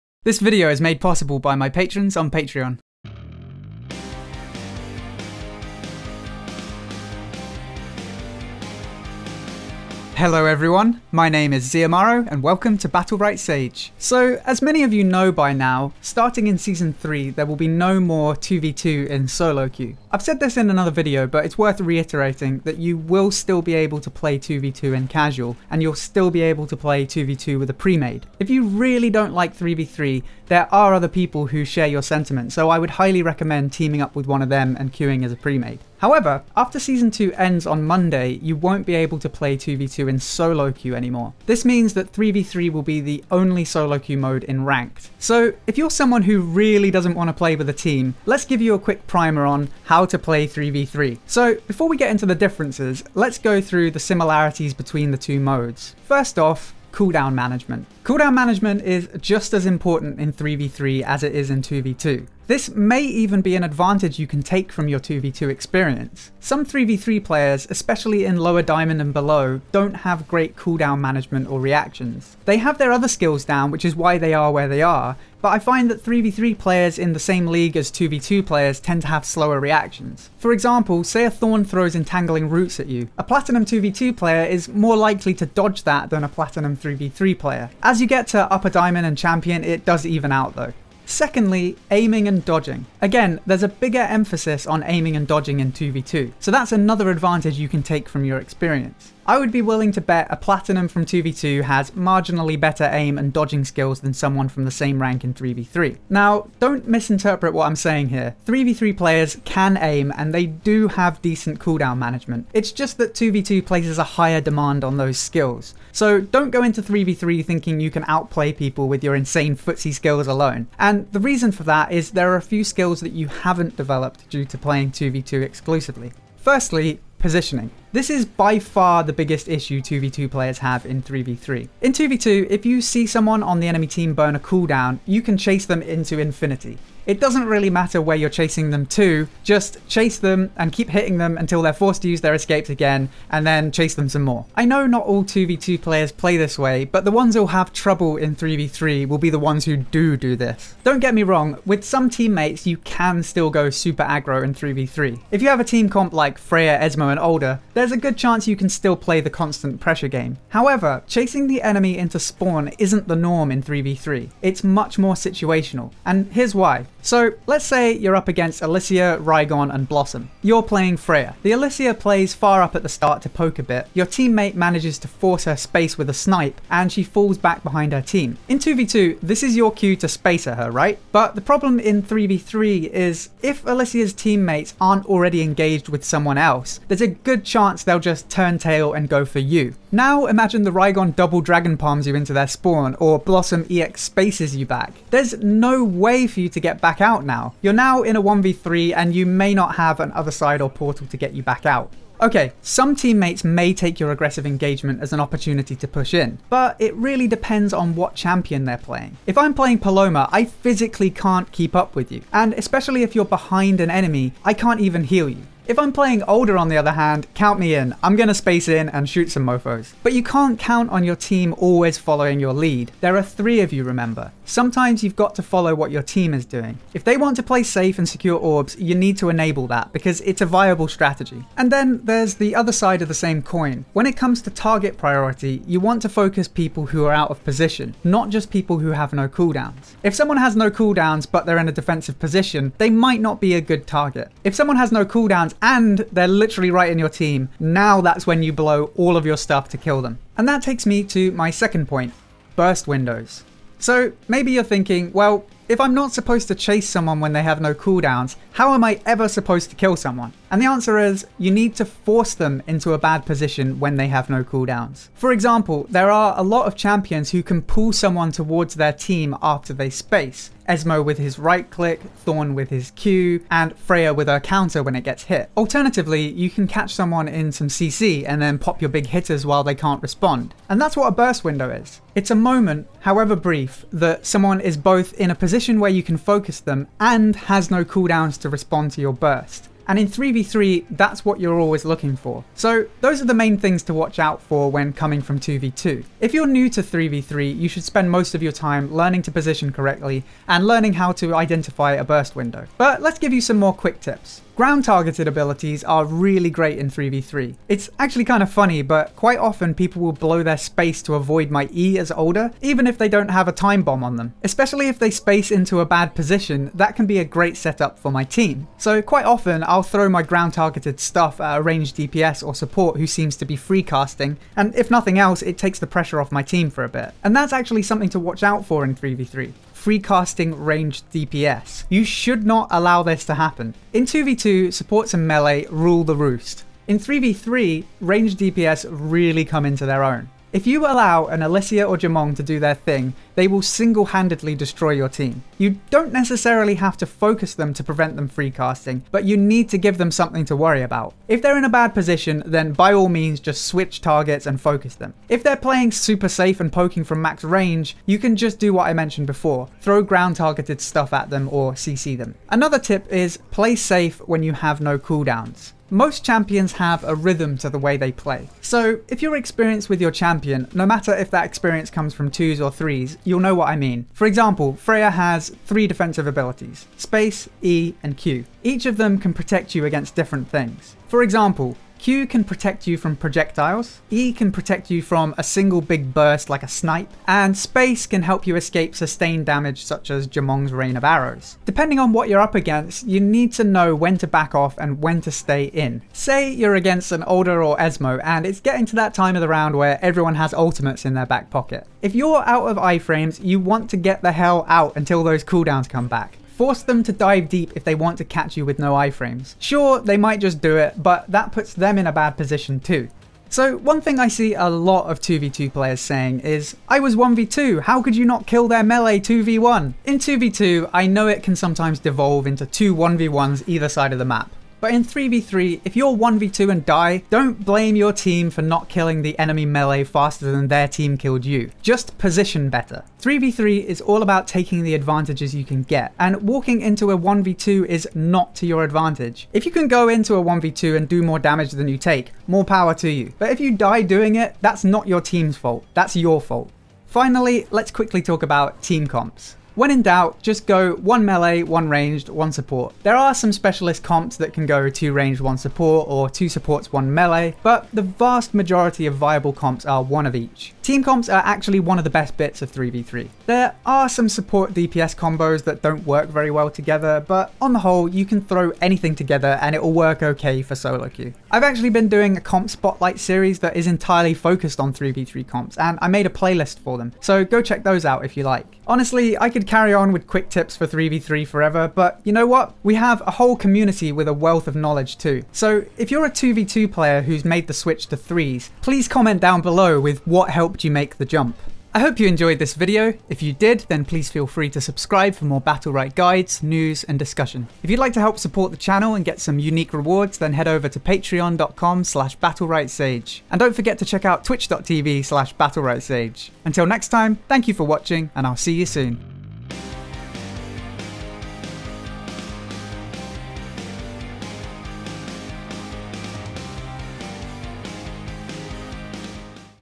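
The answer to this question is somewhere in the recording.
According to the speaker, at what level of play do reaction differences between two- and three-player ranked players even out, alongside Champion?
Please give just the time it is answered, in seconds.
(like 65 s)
88 s.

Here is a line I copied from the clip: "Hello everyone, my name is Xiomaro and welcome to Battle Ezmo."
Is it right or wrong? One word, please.
wrong.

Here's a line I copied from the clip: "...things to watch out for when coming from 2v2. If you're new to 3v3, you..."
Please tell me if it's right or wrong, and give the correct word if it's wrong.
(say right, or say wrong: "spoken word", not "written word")
right.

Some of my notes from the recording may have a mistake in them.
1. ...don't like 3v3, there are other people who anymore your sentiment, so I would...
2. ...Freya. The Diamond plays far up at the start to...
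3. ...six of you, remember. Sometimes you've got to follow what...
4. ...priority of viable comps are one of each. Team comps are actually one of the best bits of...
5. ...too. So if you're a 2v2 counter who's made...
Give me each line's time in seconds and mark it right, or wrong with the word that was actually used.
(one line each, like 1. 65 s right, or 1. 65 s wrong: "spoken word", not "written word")
1. 29 s wrong: "share", not "anymore"
2. 170 s wrong: "Alysia", not "Diamond"
3. 223 s wrong: "three", not "six"
4. 458 s wrong: "majority", not "priority"
5. 485 s wrong: "player", not "counter".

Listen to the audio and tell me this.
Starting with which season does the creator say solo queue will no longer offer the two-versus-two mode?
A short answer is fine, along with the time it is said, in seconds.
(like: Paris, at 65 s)
Season 3, at 16 s.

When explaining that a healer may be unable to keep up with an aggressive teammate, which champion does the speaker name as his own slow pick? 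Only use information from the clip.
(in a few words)
Poloma.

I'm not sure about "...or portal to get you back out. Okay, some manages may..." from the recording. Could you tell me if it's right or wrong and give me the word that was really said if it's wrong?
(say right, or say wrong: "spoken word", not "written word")
wrong: "teammates", not "manages".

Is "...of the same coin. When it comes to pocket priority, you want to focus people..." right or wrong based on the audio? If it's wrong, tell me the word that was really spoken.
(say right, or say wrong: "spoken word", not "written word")
wrong: "target", not "pocket".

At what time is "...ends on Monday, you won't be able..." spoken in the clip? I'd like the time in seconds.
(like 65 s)
37 s.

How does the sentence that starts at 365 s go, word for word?
Most champions have a rhythm to the way they play.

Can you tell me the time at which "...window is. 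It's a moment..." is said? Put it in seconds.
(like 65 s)
281 s.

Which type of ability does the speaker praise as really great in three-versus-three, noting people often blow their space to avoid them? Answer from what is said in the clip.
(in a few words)
Ground targeted abilities.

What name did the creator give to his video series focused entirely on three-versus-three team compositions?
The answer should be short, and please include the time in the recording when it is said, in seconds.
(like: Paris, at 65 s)
Comp spotlight, at 472 s.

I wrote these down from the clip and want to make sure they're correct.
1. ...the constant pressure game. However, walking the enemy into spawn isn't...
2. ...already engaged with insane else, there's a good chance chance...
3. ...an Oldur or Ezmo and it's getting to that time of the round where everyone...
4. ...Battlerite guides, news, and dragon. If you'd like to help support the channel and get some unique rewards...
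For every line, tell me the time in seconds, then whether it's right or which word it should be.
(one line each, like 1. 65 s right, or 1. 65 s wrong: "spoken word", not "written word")
1. 159 s wrong: "chasing", not "walking"
2. 185 s wrong: "someone", not "insane"
3. 397 s right
4. 495 s wrong: "discussion", not "dragon".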